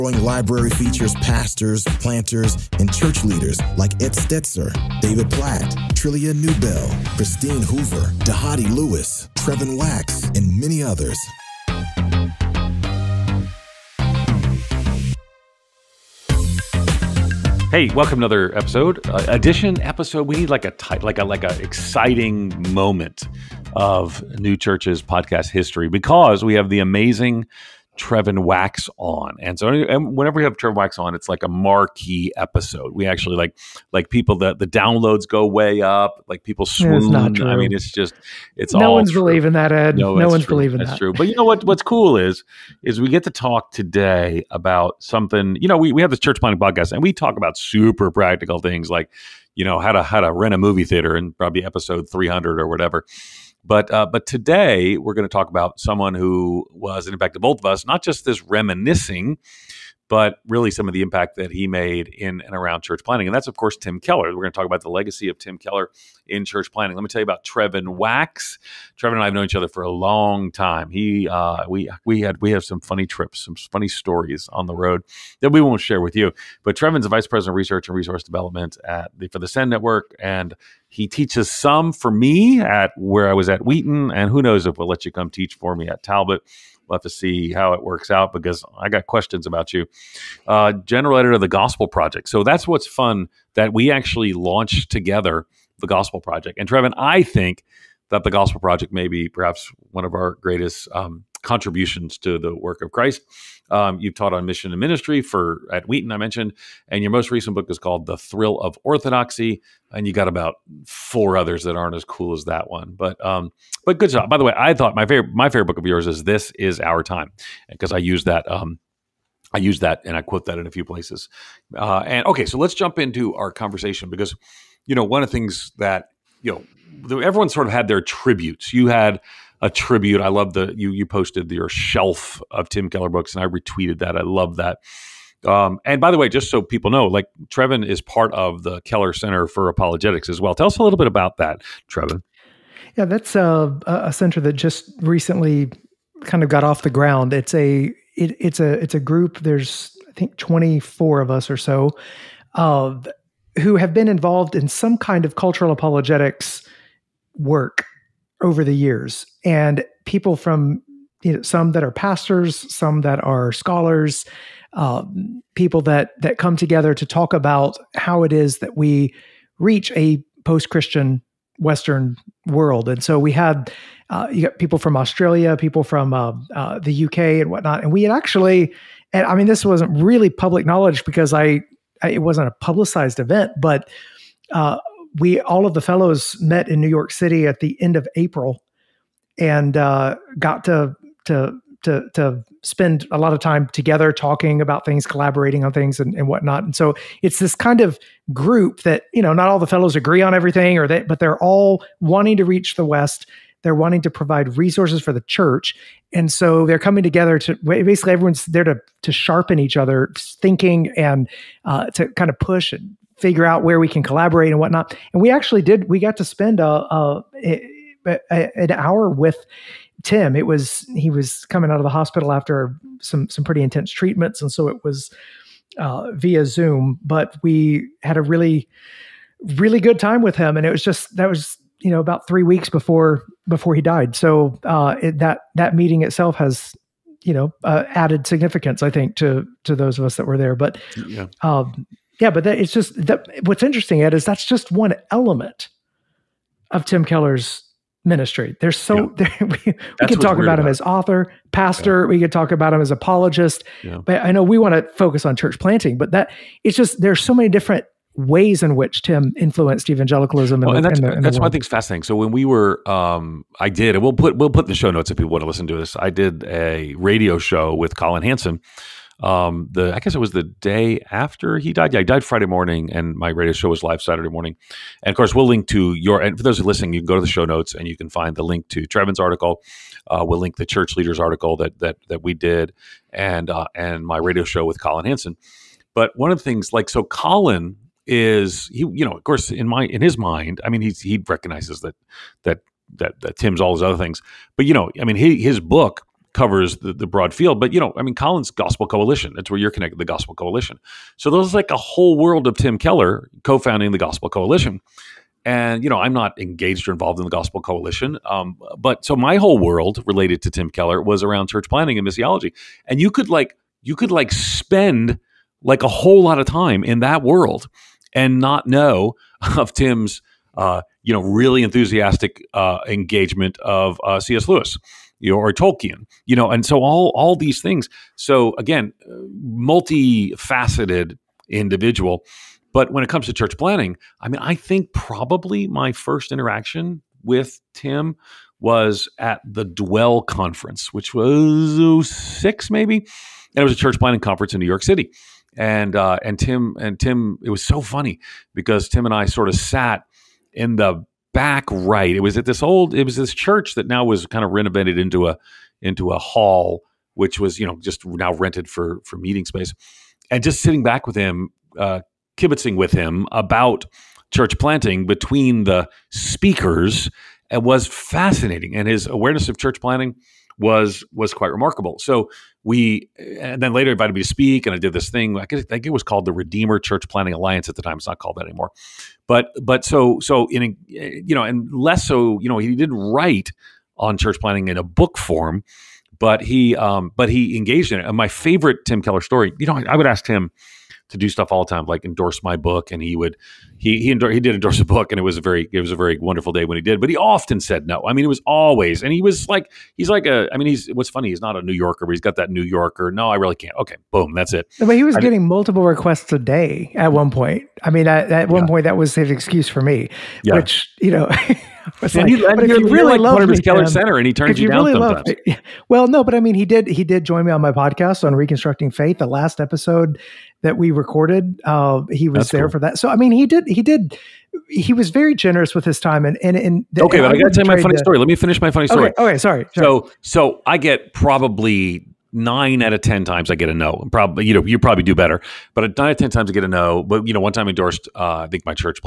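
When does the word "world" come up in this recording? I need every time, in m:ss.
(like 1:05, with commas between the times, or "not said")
2:52, 5:02, 5:09, 5:17.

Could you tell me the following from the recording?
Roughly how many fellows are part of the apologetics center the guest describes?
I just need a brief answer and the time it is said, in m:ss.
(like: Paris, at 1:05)
24, at 2:30.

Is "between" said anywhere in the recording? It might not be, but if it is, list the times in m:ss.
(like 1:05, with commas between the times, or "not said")
6:05.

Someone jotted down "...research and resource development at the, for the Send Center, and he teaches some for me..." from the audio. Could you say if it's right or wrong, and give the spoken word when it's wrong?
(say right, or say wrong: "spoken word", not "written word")
wrong: "Network", not "Center".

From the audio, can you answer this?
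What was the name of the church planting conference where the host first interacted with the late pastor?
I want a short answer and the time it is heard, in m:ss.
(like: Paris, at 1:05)
Dwell conference, at 5:39.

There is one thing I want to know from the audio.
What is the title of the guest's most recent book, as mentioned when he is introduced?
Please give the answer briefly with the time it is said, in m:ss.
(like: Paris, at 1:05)
The Thrill of Orthodoxy, at 1:48.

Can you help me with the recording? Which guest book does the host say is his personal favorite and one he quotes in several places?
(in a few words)
This Is Our Time.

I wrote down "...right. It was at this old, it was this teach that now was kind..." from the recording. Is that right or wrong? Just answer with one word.
wrong.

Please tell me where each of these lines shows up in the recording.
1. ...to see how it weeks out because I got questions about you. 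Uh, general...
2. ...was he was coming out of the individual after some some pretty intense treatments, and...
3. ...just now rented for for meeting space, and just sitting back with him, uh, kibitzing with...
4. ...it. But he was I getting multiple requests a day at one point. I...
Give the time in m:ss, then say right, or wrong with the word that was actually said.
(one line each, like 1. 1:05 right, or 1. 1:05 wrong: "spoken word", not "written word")
1. 1:27 wrong: "works", not "weeks"
2. 3:40 wrong: "hospital", not "individual"
3. 5:57 right
4. 6:44 right.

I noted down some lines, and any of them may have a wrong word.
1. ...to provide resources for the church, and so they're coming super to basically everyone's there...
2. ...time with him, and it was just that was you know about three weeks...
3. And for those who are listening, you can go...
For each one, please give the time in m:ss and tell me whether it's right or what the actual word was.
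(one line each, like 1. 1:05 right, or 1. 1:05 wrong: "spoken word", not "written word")
1. 3:24 wrong: "together", not "super"
2. 3:49 right
3. 4:36 right.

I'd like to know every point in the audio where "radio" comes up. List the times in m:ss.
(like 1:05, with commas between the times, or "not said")
4:26, 4:33, 4:44.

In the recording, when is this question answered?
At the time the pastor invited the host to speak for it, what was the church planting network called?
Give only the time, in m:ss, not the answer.
6:16.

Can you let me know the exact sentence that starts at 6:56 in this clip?
He did join me on my podcast on reconstructing faith.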